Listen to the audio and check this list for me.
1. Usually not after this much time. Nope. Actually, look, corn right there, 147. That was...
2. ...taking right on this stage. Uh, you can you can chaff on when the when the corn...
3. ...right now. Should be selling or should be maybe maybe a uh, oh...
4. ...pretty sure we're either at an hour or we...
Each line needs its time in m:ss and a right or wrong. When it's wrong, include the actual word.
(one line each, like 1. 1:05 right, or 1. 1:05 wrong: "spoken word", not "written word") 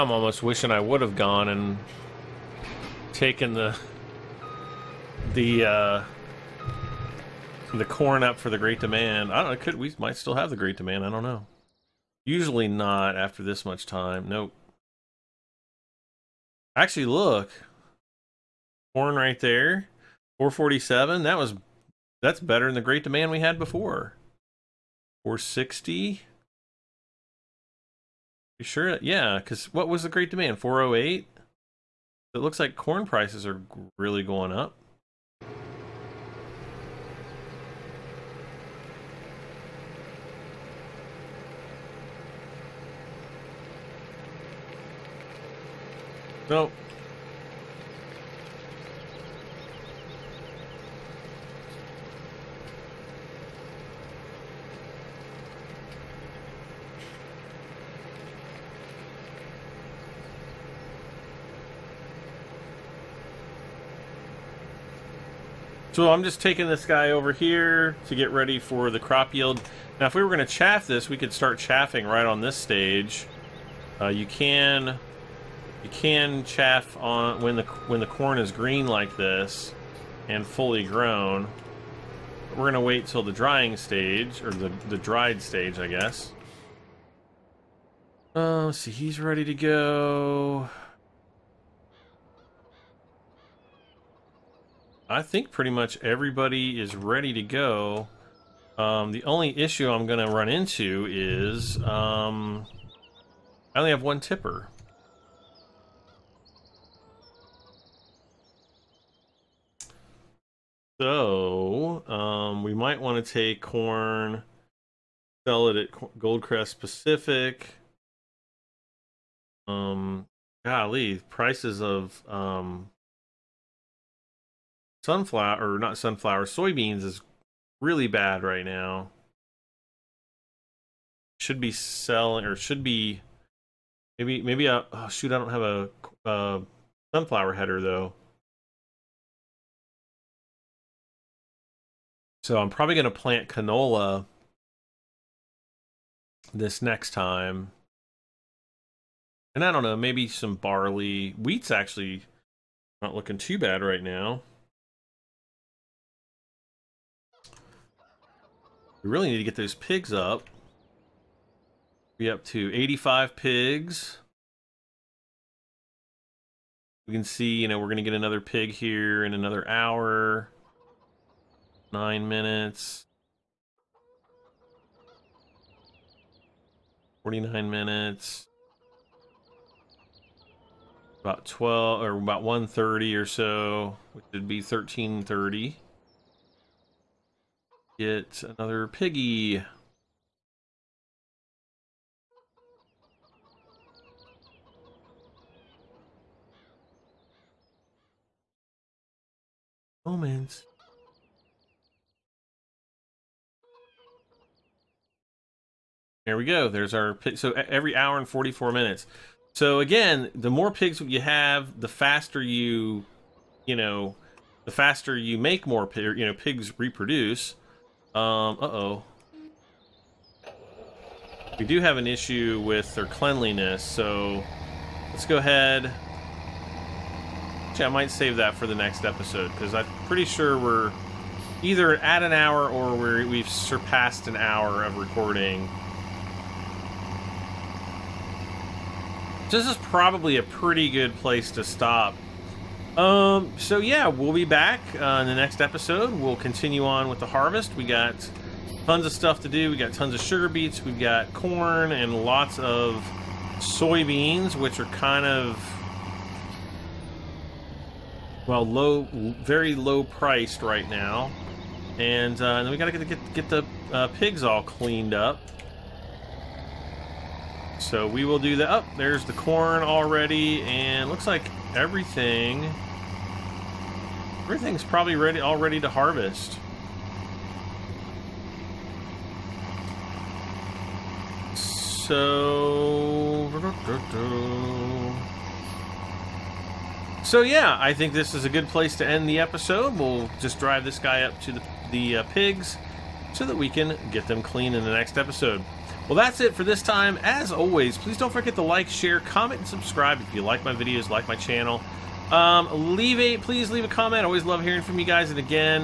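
1. 0:12 wrong: "447", not "147"
2. 1:11 wrong: "chaffing", not "taking"
3. 2:08 right
4. 3:50 right.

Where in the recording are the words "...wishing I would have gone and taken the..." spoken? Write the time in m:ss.
0:00.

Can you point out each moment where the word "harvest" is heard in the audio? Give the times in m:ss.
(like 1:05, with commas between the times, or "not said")
4:07, 4:35.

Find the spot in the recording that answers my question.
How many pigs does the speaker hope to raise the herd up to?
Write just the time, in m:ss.
2:42.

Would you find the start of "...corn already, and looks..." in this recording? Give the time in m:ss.
4:29.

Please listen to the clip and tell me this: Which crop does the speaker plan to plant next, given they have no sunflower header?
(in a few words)
canola.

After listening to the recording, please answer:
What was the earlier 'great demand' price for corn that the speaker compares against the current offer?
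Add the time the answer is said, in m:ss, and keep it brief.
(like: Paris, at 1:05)
408, at 0:30.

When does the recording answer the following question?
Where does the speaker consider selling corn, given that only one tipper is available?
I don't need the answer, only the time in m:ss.
1:56.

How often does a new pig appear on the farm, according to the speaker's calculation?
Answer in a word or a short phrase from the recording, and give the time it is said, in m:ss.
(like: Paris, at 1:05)
every 1 hour 44 minutes, at 3:27.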